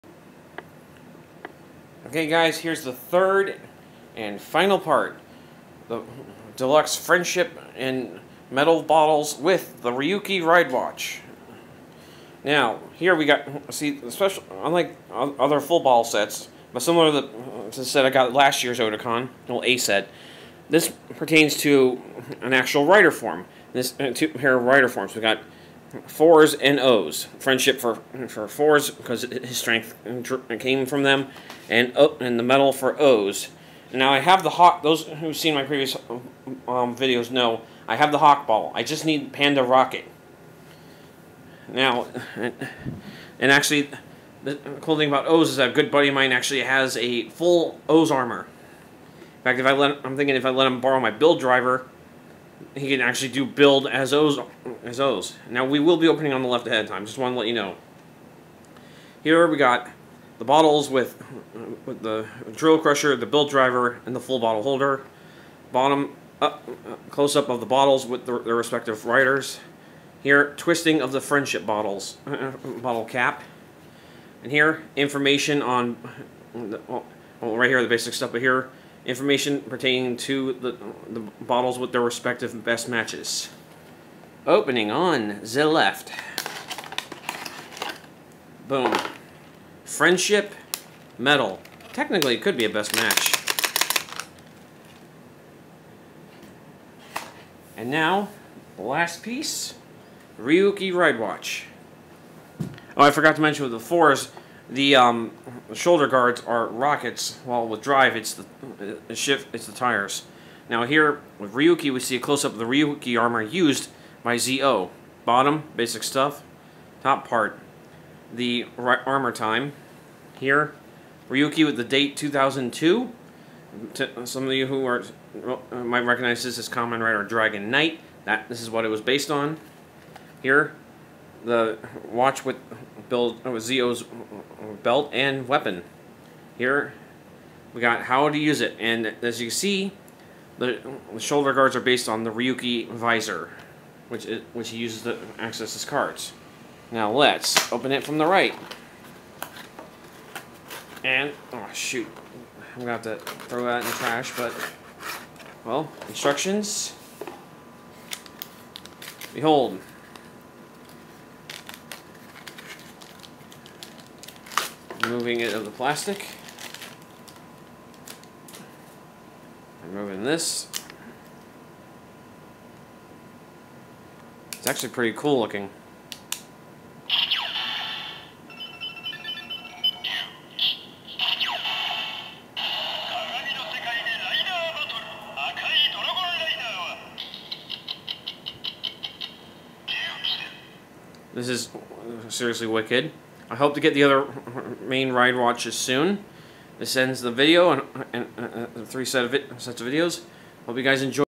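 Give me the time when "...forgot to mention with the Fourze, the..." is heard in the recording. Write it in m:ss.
1:43.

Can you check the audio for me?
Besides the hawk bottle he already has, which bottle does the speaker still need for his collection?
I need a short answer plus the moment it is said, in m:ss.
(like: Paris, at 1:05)
Panda Rocket, at 0:39.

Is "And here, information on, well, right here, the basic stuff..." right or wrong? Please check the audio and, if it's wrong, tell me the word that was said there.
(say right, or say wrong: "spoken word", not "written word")
right.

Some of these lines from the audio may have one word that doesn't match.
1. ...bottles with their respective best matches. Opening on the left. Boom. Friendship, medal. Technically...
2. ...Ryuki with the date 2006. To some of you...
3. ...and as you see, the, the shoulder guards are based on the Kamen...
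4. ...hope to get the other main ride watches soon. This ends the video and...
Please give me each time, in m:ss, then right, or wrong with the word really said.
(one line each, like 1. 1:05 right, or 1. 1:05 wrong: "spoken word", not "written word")
1. 1:21 right
2. 2:01 wrong: "2002", not "2006"
3. 2:18 wrong: "Ryuki", not "Kamen"
4. 3:13 right.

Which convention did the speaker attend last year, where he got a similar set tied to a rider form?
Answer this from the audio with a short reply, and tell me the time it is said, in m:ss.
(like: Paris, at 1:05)
Otakon, at 0:18.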